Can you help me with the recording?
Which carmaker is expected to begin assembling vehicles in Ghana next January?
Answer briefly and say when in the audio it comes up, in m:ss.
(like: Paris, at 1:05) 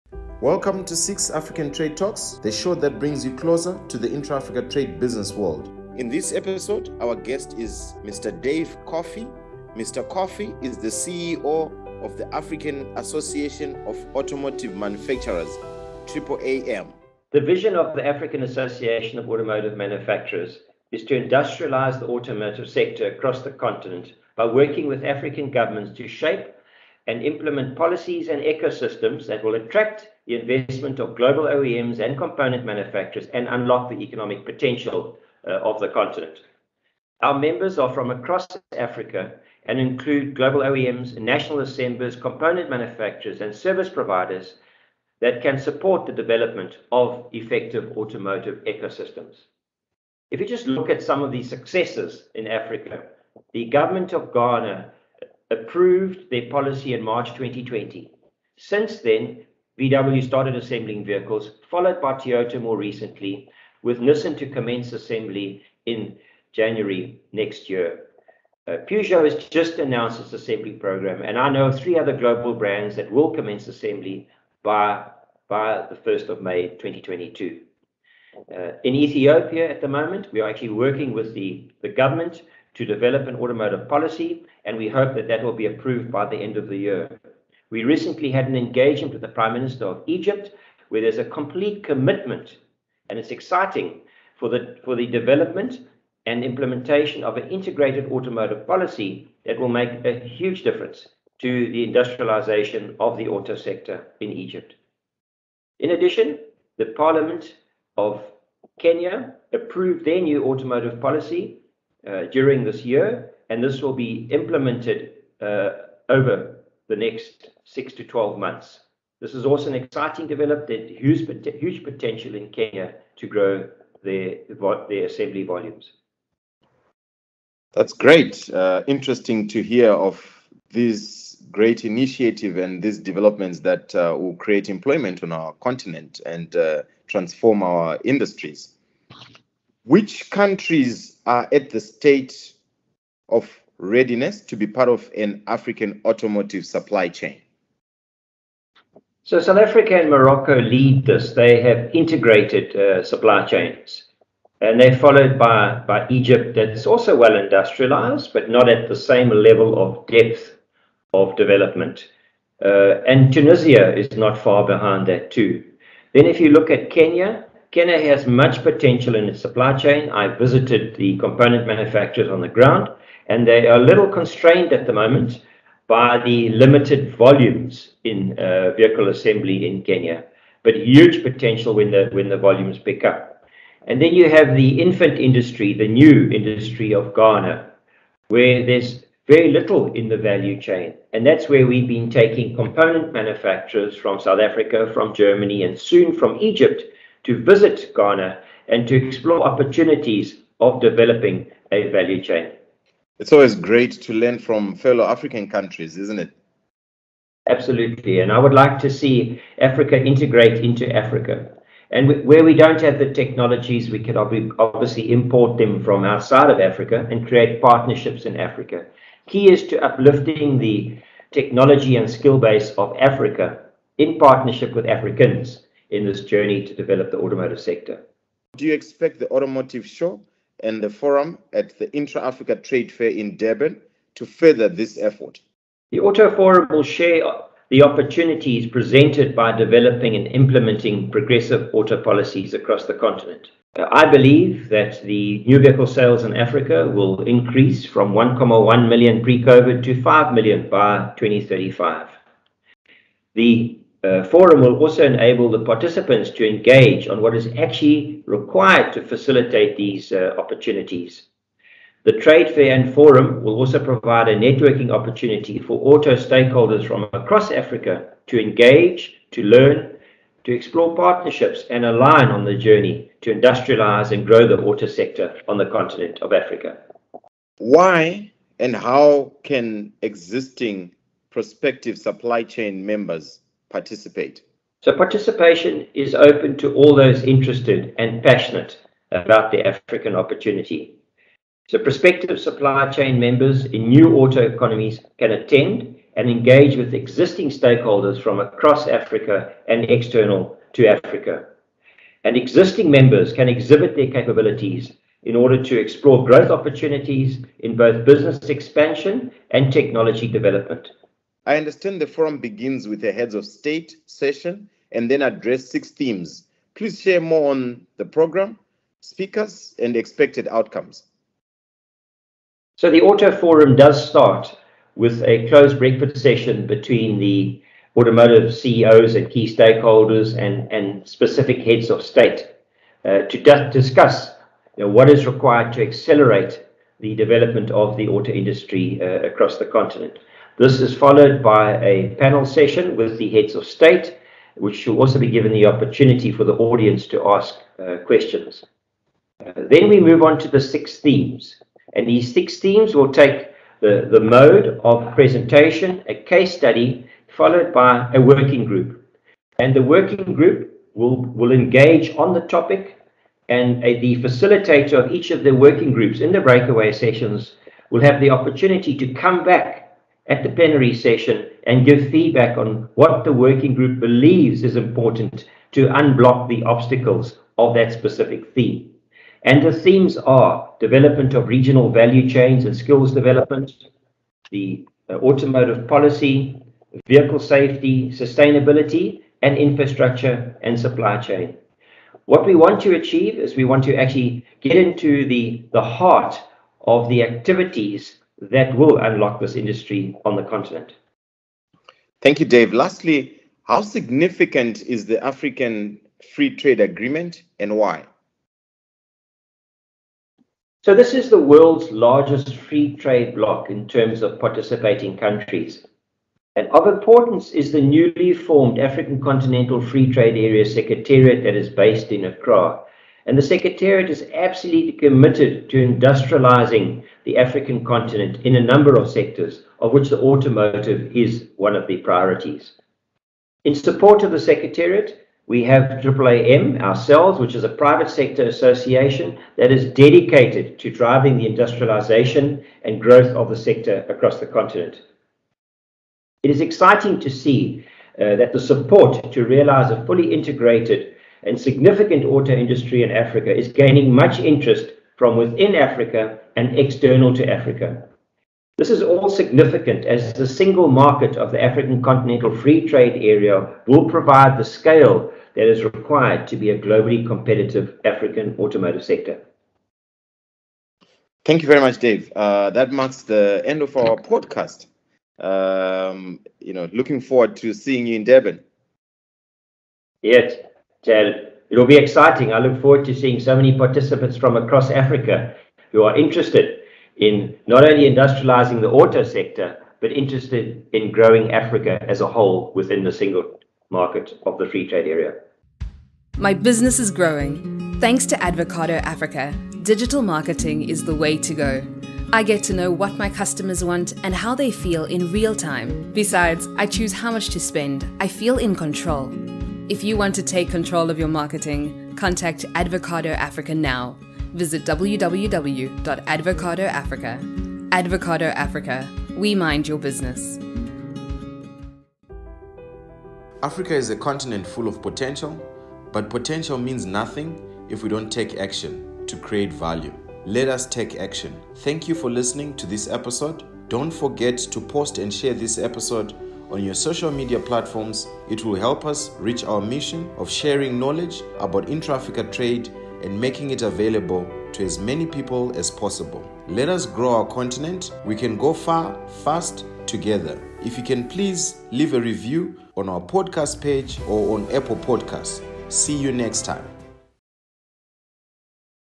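Nissan, at 1:04.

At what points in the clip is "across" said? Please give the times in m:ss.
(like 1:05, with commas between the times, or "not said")
0:23, 0:38, 4:02, 4:27, 4:58, 5:39, 7:24, 8:04.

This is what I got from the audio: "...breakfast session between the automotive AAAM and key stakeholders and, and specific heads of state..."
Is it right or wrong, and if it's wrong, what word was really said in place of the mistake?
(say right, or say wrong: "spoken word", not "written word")
wrong: "CEOs", not "AAAM".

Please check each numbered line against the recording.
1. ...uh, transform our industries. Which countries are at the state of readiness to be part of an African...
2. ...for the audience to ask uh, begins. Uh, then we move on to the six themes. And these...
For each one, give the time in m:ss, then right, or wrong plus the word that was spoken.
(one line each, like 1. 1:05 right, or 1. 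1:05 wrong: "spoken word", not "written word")
1. 2:16 right
2. 5:46 wrong: "questions", not "begins".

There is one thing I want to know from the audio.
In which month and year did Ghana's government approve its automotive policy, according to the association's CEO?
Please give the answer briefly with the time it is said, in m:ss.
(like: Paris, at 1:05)
March 2020, at 0:57.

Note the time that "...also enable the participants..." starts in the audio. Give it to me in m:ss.
4:14.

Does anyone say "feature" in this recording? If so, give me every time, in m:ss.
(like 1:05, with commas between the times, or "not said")
not said.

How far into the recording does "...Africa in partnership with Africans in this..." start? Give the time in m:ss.
3:42.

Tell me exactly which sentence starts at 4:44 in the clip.
So participation is open to all those interested and passionate about the African opportunity.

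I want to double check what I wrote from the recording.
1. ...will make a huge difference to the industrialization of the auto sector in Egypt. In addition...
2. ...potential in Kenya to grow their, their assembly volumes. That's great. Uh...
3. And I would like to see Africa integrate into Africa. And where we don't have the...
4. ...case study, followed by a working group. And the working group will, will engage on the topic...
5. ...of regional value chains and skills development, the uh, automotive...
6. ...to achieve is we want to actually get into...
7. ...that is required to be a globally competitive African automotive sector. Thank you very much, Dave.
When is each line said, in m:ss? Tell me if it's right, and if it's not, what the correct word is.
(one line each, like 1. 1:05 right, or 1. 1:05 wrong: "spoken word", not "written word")
1. 1:39 right
2. 2:01 right
3. 3:28 right
4. 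5:56 right
5. 6:21 right
6. 6:32 right
7. 7:45 right.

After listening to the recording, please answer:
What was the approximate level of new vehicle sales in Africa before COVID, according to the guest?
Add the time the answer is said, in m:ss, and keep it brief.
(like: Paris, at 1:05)
1.1 million, at 4:08.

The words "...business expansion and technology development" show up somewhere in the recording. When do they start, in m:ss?
5:08.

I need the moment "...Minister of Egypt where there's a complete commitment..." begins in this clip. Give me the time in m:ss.
1:29.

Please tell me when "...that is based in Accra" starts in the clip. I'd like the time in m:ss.
7:01.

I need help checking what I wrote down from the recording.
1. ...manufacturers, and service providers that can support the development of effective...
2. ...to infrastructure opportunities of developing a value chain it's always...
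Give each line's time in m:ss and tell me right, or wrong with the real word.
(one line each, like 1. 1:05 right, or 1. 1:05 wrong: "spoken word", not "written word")
1. 0:42 right
2. 3:18 wrong: "explore", not "infrastructure".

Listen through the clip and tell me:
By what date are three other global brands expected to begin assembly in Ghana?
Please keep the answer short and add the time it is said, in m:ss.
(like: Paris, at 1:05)
1st of May 2022, at 1:15.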